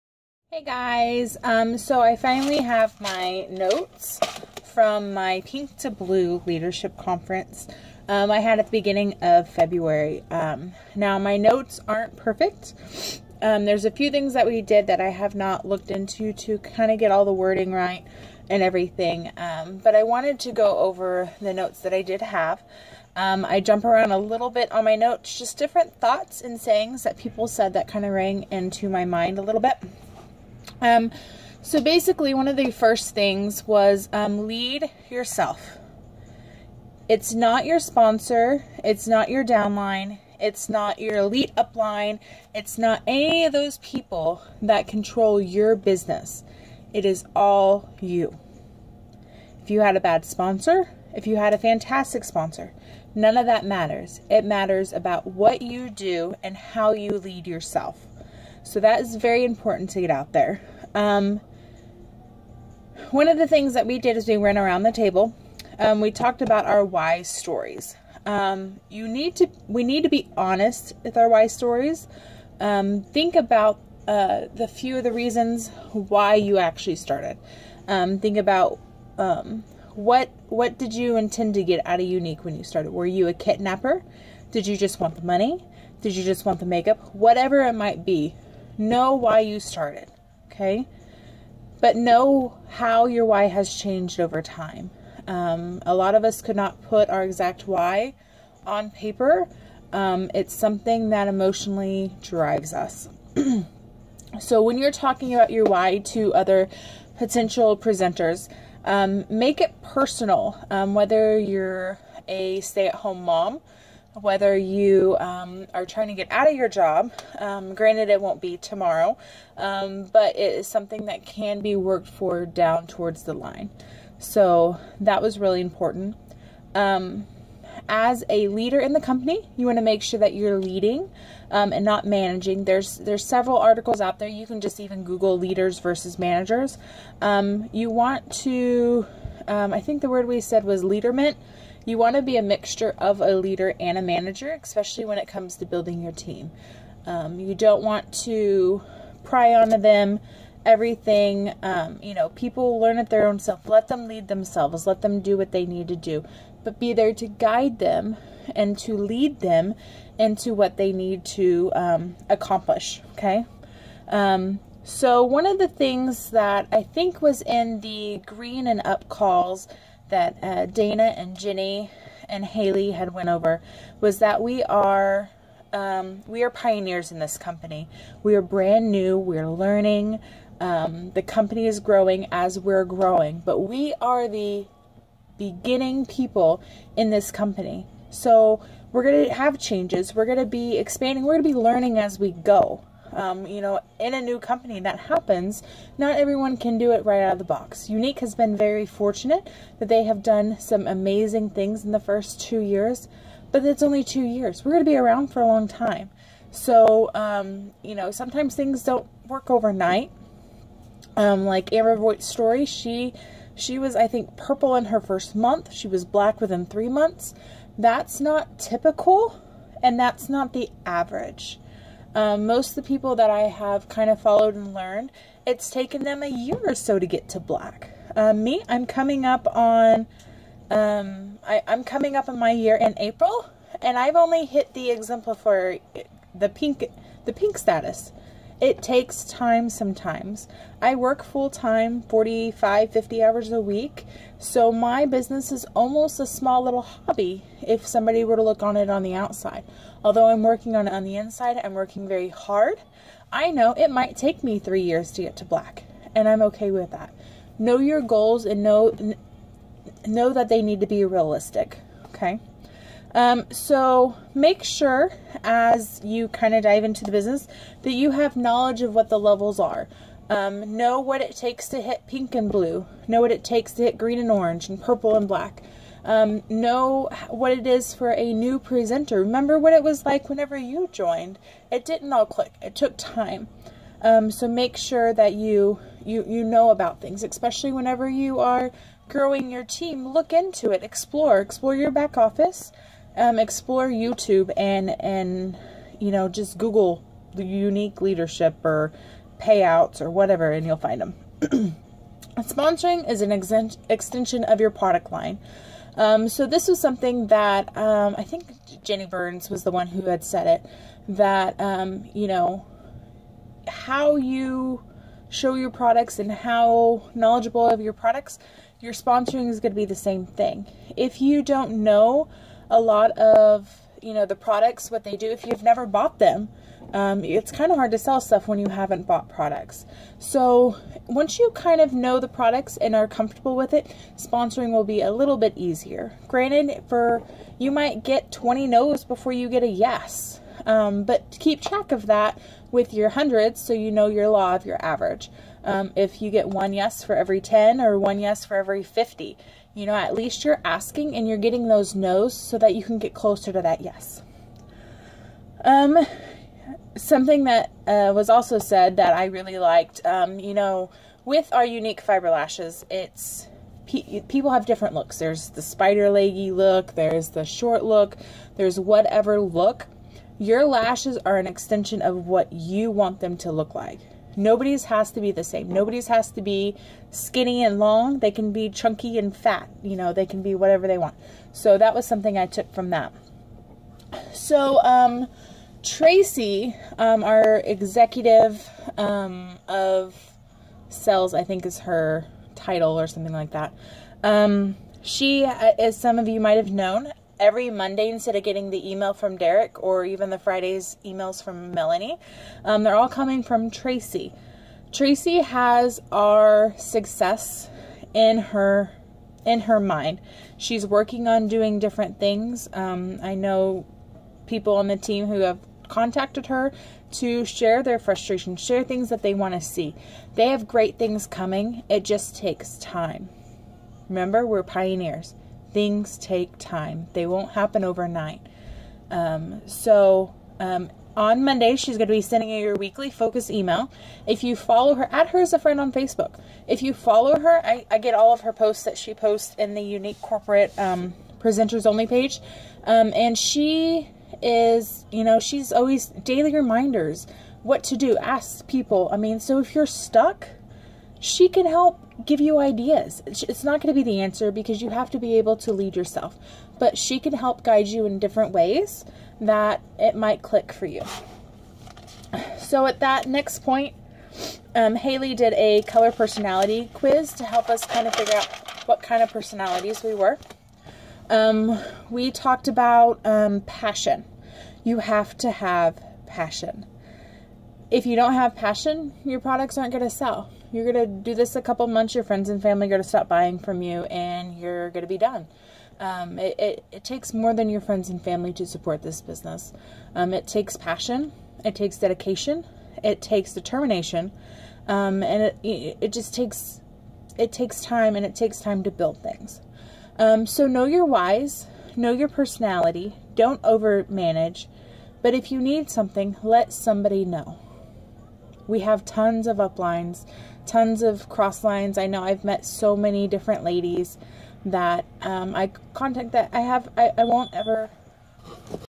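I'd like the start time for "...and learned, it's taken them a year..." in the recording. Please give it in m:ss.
3:44.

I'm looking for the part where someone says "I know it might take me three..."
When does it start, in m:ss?
4:13.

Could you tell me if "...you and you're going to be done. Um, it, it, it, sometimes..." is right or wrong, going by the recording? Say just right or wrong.
wrong.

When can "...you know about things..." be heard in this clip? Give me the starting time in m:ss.
4:46.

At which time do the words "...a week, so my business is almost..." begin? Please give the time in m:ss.
4:03.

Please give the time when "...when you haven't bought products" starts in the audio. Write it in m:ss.
5:28.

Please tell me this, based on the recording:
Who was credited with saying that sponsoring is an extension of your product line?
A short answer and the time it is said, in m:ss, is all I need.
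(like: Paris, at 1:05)
Jenny Burns, at 5:08.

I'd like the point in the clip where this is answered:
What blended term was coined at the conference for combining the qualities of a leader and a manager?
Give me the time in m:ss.
2:20.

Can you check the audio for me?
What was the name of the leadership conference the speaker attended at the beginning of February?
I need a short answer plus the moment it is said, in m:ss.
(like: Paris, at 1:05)
Pink to Blue Leadership Conference, at 0:05.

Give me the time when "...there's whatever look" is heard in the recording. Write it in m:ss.
6:08.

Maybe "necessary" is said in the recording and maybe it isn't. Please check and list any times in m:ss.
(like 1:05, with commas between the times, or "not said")
not said.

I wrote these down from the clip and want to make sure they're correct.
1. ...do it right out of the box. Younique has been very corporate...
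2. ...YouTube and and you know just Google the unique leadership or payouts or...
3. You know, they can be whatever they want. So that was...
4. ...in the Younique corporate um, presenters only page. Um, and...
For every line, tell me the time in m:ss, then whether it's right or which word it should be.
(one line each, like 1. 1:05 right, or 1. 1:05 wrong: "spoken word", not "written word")
1. 3:16 wrong: "fortunate", not "corporate"
2. 4:53 right
3. 6:19 right
4. 7:19 right.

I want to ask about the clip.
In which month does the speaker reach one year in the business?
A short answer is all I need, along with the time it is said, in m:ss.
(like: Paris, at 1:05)
April, at 3:52.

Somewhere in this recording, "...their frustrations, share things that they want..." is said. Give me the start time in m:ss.
6:57.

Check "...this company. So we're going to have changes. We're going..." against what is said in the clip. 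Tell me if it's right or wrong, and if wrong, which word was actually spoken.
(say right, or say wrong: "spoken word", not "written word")
right.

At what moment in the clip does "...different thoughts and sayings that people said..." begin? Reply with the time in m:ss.
0:25.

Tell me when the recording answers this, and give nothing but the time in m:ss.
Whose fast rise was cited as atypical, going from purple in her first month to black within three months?
3:31.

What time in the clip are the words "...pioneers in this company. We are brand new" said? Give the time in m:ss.
2:56.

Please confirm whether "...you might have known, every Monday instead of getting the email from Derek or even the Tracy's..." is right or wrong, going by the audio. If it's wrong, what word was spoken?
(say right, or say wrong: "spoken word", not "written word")
wrong: "Friday", not "Tracy".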